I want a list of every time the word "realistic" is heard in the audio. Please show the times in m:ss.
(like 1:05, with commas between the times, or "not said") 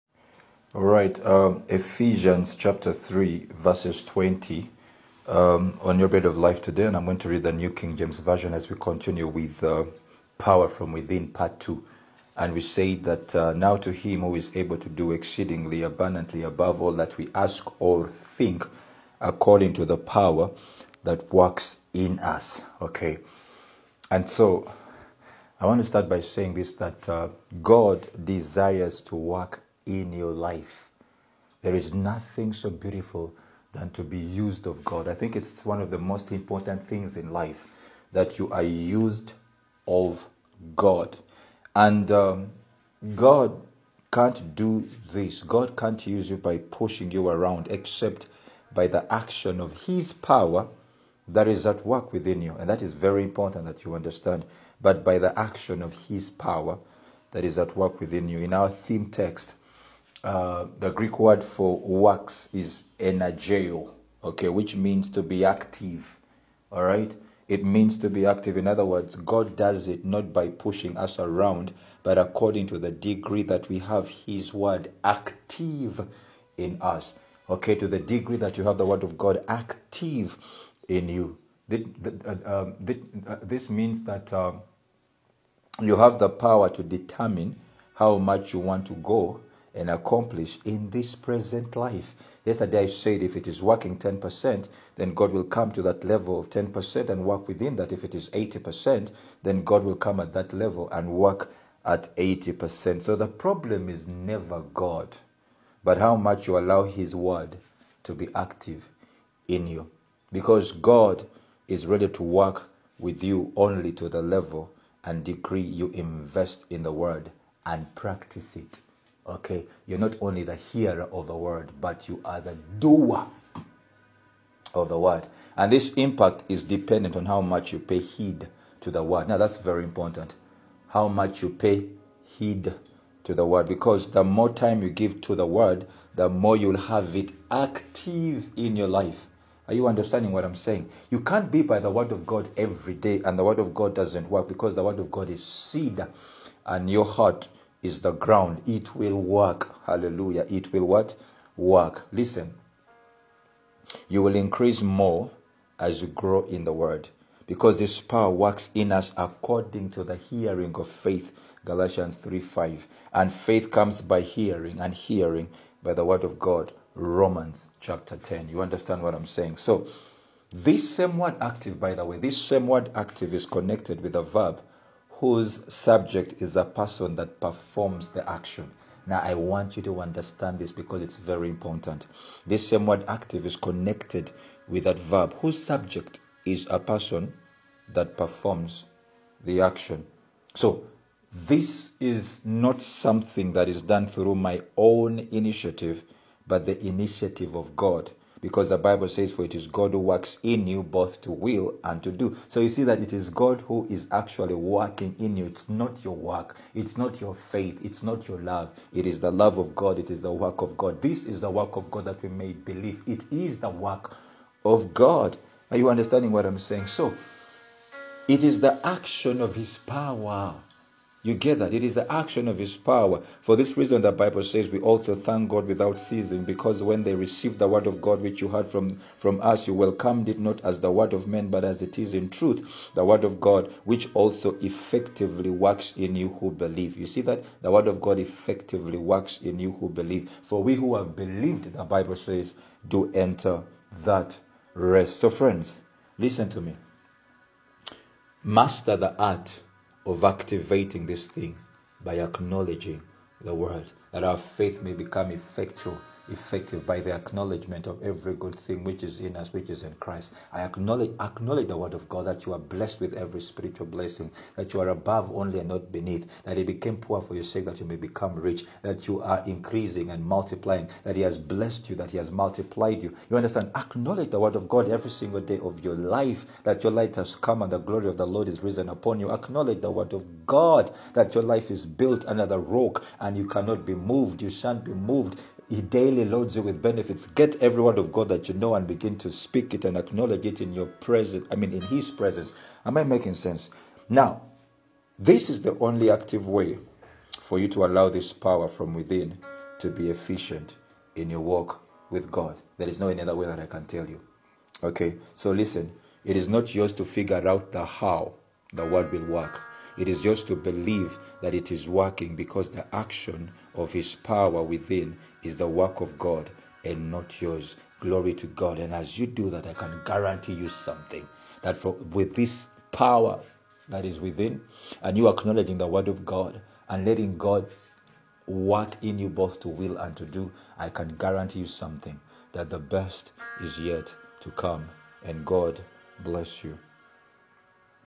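not said.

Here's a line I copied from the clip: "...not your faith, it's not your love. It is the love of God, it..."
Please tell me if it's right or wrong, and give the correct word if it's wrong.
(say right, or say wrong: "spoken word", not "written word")
right.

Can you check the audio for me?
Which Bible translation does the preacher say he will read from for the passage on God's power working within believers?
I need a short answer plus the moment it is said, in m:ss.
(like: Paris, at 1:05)
New King James Version, at 0:07.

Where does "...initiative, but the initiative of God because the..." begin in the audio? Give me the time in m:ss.
3:15.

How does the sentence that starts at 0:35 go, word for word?
I think it's one of the most important things in life that you are used of God.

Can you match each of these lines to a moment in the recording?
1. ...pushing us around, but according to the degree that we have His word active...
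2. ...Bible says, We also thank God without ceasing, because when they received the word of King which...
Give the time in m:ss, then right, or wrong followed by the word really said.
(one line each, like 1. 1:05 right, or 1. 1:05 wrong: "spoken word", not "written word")
1. 1:10 right
2. 3:44 wrong: "God", not "King".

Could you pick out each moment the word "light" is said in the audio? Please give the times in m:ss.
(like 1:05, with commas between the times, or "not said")
4:36.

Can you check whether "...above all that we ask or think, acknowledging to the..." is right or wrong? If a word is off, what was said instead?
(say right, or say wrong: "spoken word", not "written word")
wrong: "according", not "acknowledging".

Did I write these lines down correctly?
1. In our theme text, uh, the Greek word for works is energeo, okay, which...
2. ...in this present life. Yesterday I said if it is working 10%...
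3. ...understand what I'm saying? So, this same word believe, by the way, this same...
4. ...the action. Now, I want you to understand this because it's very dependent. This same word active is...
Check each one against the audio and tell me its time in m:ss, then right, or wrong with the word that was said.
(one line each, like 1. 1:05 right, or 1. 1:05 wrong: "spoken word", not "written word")
1. 0:58 right
2. 1:30 right
3. 2:48 wrong: "active", not "believe"
4. 2:58 wrong: "important", not "dependent".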